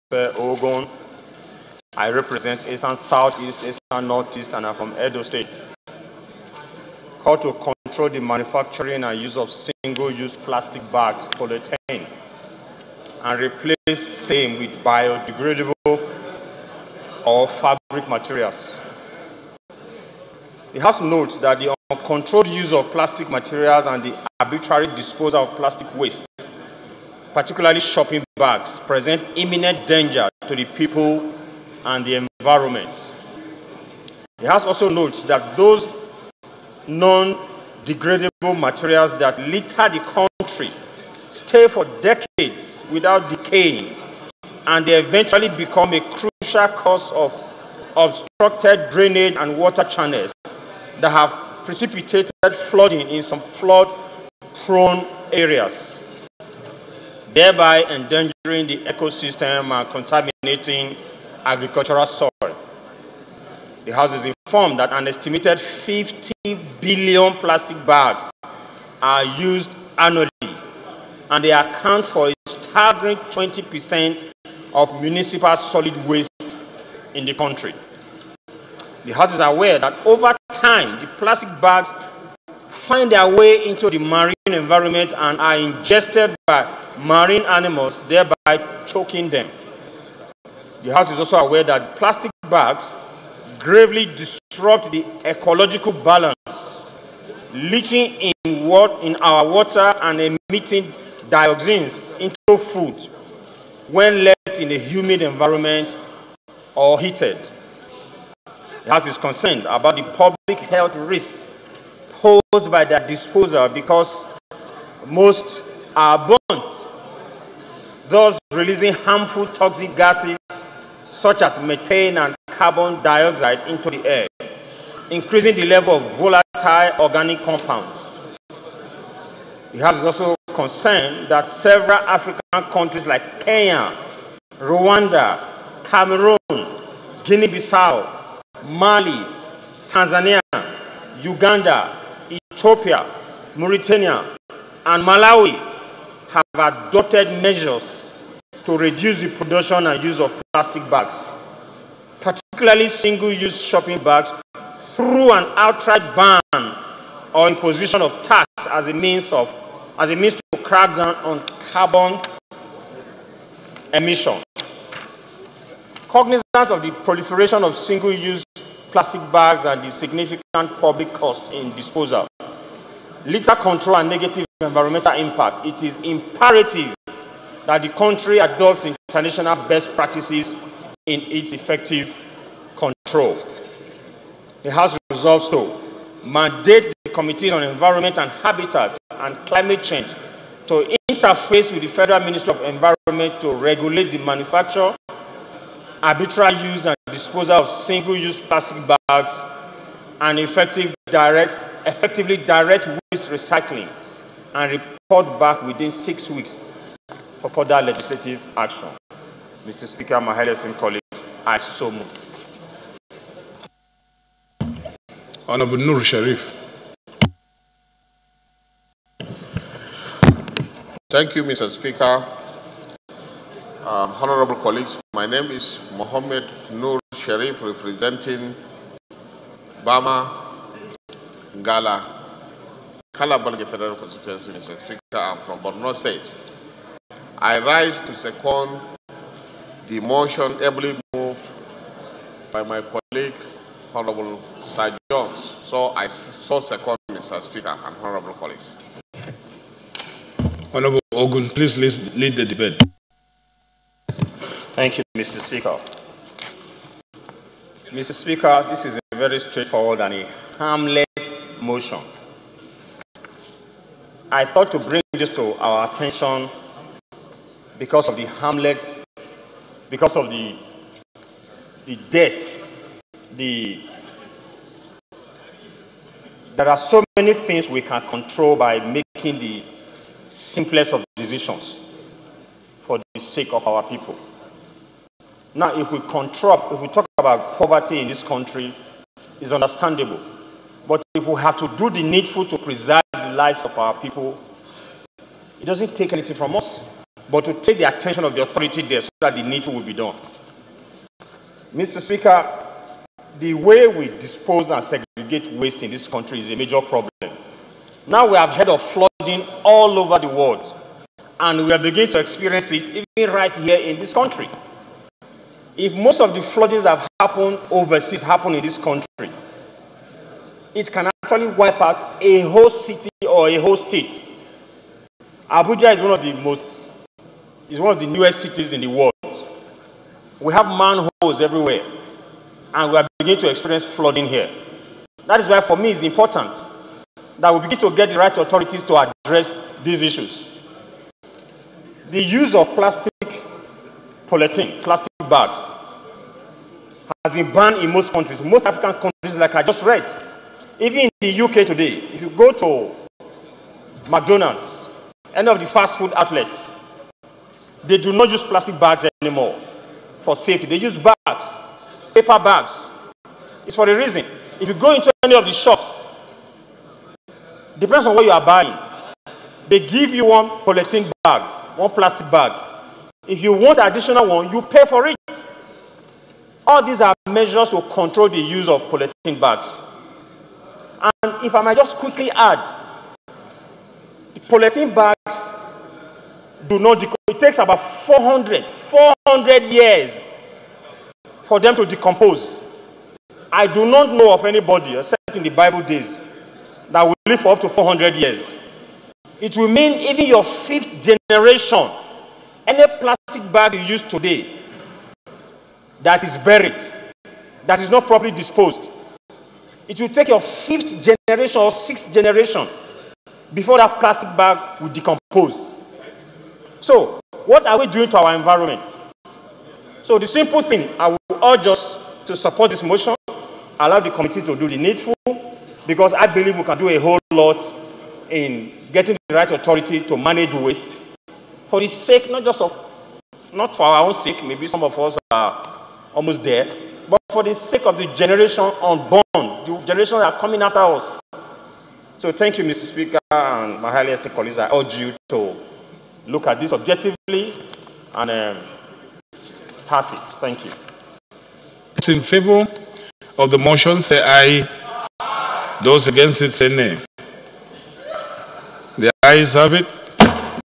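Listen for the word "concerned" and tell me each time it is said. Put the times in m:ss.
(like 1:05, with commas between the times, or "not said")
1:49, 2:10.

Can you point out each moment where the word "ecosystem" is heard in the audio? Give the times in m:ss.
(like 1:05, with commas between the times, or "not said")
0:58.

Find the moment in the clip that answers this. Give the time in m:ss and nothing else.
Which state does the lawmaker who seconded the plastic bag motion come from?
3:55.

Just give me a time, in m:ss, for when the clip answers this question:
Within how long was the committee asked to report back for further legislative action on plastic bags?
3:25.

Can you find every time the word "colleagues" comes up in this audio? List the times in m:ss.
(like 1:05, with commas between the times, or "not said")
3:30, 3:44, 4:02, 4:08, 7:24.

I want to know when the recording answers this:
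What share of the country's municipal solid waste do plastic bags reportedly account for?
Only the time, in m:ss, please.
1:13.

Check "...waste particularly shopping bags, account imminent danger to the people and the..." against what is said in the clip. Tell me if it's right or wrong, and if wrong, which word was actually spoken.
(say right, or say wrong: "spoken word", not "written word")
wrong: "present", not "account".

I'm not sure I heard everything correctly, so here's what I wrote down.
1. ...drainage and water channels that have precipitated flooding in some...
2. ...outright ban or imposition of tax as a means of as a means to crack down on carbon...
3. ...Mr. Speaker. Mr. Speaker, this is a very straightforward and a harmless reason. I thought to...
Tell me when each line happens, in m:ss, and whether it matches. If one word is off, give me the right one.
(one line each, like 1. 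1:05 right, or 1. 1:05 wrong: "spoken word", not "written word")
1. 0:48 right
2. 2:35 right
3. 4:15 wrong: "motion", not "reason".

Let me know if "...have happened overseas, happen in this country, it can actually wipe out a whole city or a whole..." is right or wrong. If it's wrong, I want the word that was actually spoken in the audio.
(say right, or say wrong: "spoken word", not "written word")
right.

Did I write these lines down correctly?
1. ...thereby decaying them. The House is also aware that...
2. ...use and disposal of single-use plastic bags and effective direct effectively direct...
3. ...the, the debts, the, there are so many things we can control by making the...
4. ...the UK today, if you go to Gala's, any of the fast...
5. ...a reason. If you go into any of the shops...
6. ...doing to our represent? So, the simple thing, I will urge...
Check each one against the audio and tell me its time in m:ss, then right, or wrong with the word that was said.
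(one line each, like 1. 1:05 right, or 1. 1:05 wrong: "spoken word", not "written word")
1. 1:28 wrong: "choking", not "decaying"
2. 3:16 right
3. 4:30 right
4. 5:51 wrong: "McDonald", not "Gala"
5. 6:03 right
6. 6:57 wrong: "environment", not "represent".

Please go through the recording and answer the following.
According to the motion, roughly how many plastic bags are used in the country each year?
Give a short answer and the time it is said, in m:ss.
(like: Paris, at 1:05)
50 billion, at 1:05.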